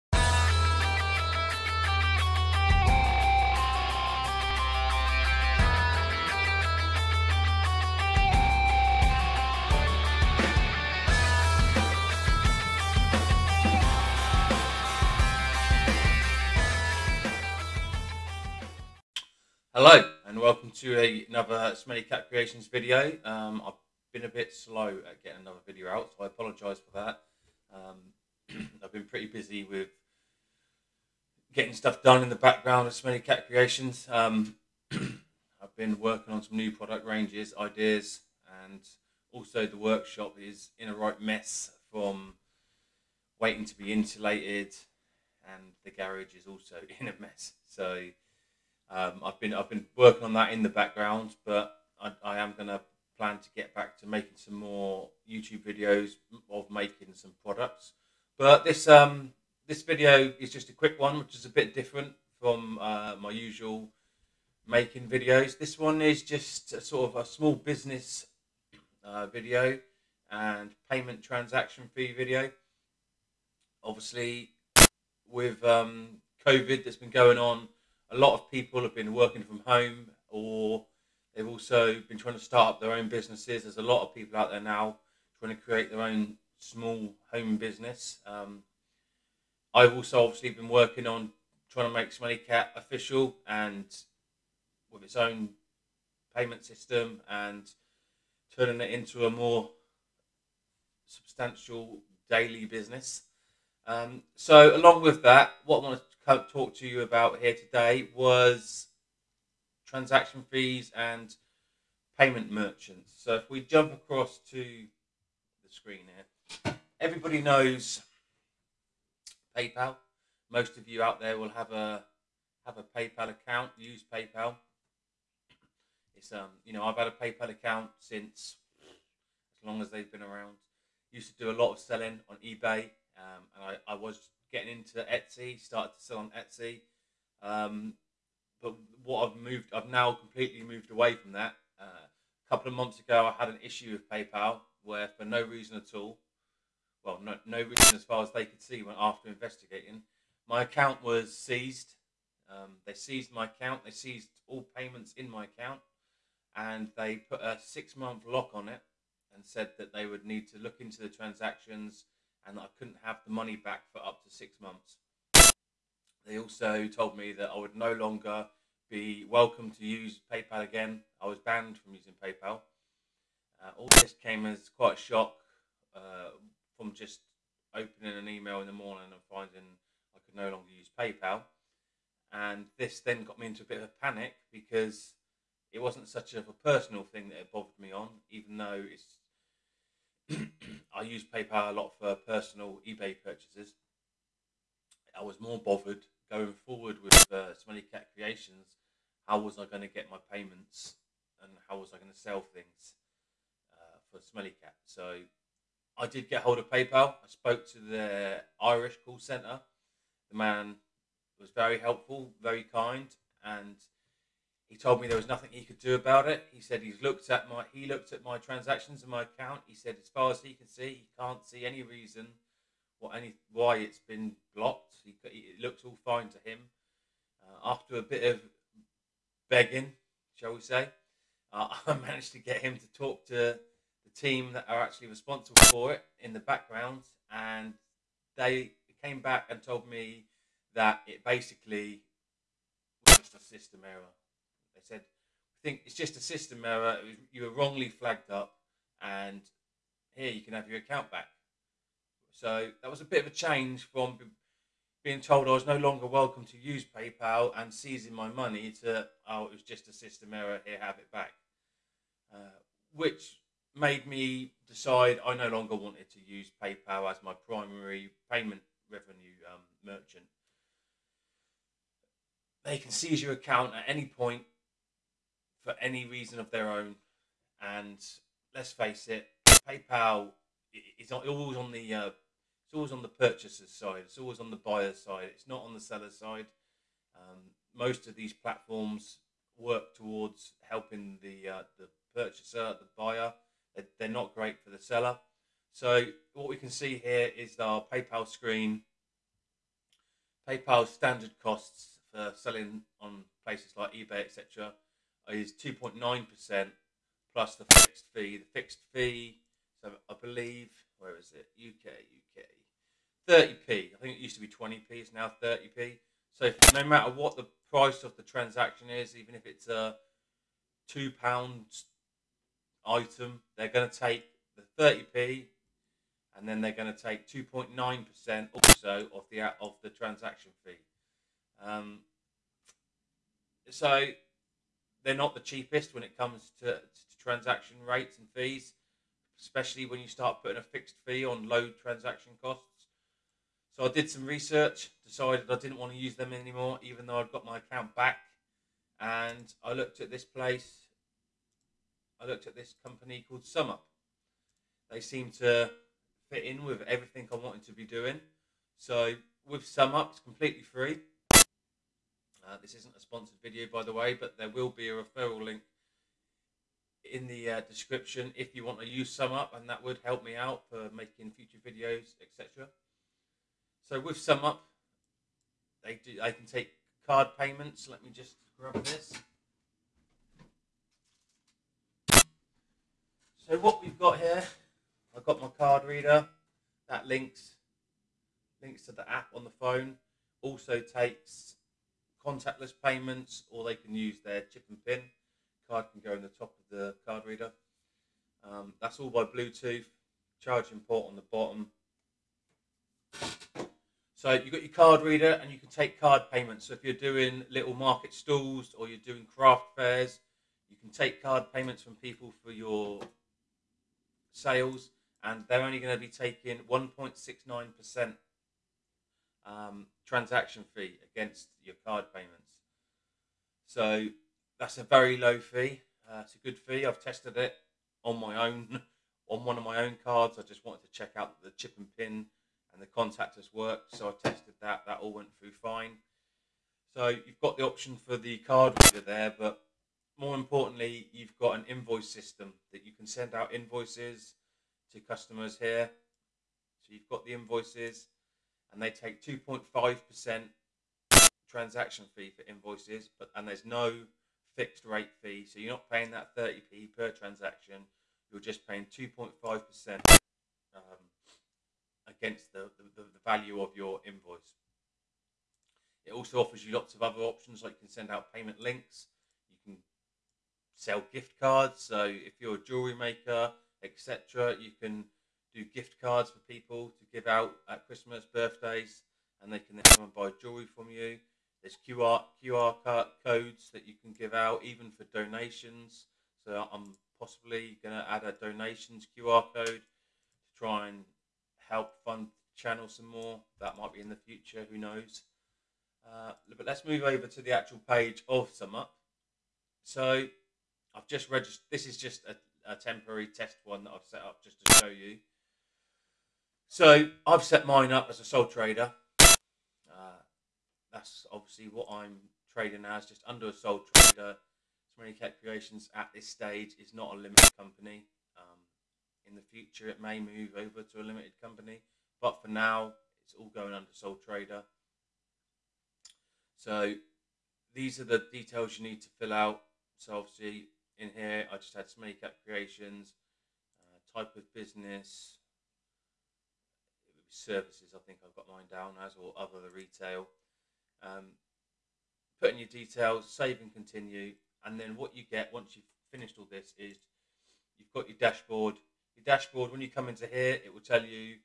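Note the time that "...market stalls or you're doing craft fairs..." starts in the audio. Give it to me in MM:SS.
06:47.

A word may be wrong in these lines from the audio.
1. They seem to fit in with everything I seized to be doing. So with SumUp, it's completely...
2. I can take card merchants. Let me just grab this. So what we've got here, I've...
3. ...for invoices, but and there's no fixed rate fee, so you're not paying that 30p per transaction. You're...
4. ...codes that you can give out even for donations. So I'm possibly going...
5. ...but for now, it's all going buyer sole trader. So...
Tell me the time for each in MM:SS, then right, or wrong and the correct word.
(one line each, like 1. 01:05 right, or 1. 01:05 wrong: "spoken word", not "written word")
1. 05:54 wrong: "wanted", not "seized"
2. 06:16 wrong: "payments", not "merchants"
3. 07:32 right
4. 08:03 right
5. 08:42 wrong: "under", not "buyer".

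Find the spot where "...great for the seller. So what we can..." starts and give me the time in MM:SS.
04:54.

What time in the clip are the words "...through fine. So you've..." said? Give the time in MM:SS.
07:15.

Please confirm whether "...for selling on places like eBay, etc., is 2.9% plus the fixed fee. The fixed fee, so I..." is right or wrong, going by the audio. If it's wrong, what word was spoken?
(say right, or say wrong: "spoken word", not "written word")
right.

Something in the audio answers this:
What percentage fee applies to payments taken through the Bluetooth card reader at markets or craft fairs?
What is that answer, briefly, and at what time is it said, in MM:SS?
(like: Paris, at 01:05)
1.69%, at 06:56.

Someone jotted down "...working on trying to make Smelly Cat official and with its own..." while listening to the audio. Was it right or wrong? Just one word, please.
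right.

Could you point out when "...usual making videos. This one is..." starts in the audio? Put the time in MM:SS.
01:03.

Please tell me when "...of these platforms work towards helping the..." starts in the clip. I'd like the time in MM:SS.
04:48.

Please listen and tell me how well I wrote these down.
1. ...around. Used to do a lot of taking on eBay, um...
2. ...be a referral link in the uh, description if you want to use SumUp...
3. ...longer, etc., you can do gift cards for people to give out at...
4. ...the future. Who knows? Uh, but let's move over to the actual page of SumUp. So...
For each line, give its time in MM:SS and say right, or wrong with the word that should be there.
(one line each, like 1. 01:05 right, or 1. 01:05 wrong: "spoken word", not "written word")
1. 02:10 wrong: "selling", not "taking"
2. 06:04 right
3. 07:52 wrong: "maker", not "longer"
4. 08:14 right.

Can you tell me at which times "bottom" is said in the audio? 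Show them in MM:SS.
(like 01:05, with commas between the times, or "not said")
06:41.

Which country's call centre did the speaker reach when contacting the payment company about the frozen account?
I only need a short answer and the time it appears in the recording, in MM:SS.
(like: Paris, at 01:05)
Irish, at 03:28.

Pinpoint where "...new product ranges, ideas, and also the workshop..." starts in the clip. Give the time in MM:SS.
00:36.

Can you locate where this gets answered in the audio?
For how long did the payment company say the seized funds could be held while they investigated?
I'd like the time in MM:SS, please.
02:44.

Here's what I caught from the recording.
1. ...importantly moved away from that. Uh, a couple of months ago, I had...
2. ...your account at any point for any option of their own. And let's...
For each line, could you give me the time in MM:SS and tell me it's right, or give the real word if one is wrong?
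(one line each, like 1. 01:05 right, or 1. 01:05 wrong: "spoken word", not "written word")
1. 02:20 wrong: "completely", not "importantly"
2. 04:33 wrong: "reason", not "option".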